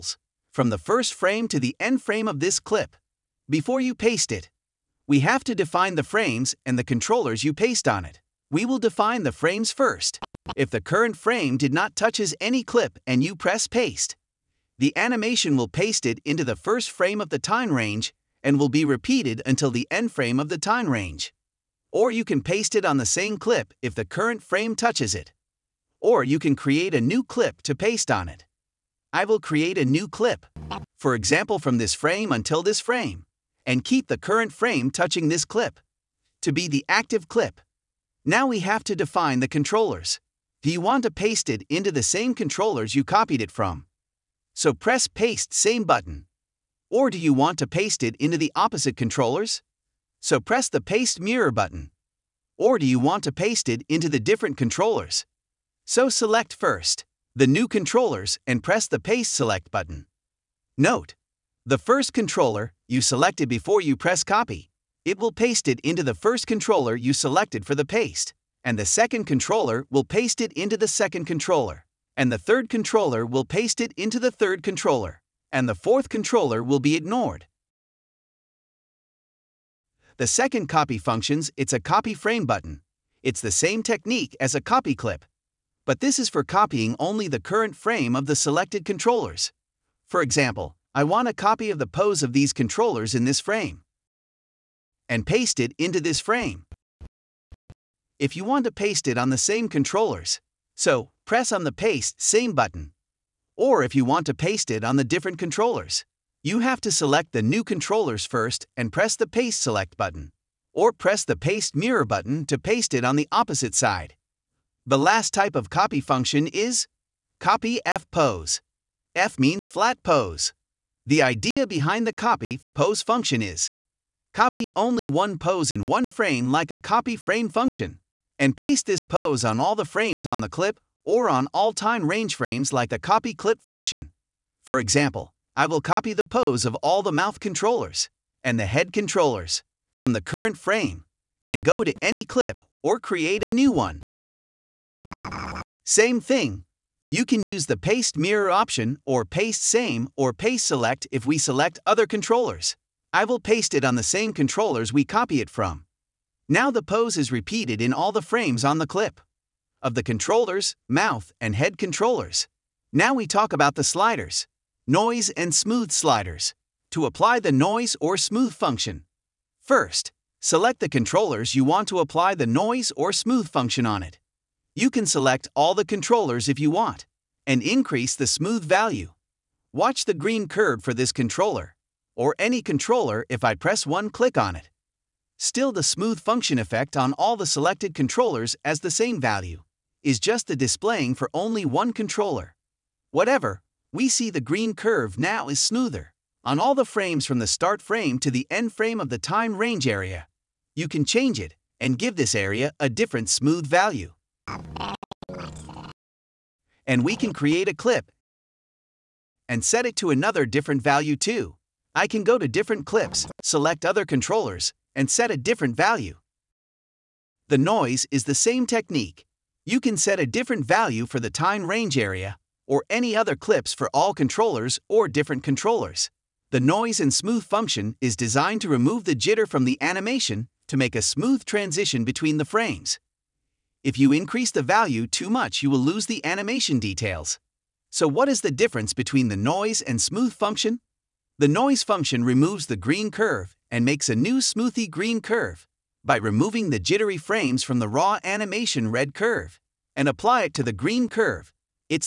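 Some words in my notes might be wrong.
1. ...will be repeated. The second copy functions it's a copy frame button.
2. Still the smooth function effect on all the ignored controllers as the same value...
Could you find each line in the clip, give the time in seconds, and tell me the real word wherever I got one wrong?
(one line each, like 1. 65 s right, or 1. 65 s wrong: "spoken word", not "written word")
1. 76 s wrong: "ignored", not "repeated"
2. 185 s wrong: "selected", not "ignored".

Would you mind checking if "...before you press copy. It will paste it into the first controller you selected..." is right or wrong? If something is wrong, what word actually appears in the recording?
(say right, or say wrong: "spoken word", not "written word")
right.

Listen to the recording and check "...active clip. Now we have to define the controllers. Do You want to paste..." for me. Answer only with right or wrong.
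right.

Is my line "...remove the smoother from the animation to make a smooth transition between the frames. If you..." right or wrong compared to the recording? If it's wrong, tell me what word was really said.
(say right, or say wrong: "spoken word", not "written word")
wrong: "jitter", not "smoother".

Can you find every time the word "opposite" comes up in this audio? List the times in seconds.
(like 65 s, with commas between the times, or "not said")
48 s, 113 s.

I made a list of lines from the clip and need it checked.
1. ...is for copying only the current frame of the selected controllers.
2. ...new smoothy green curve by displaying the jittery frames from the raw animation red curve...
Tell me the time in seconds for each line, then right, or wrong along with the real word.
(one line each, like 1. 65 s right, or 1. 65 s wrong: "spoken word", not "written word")
1. 86 s right
2. 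244 s wrong: "removing", not "displaying".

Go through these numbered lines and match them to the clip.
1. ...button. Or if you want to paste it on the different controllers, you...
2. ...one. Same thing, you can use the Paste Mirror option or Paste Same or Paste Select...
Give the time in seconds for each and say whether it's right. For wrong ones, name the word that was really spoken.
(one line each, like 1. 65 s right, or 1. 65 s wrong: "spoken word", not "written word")
1. 102 s right
2. 143 s right.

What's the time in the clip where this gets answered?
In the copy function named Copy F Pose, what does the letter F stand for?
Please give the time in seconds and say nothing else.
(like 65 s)
119 s.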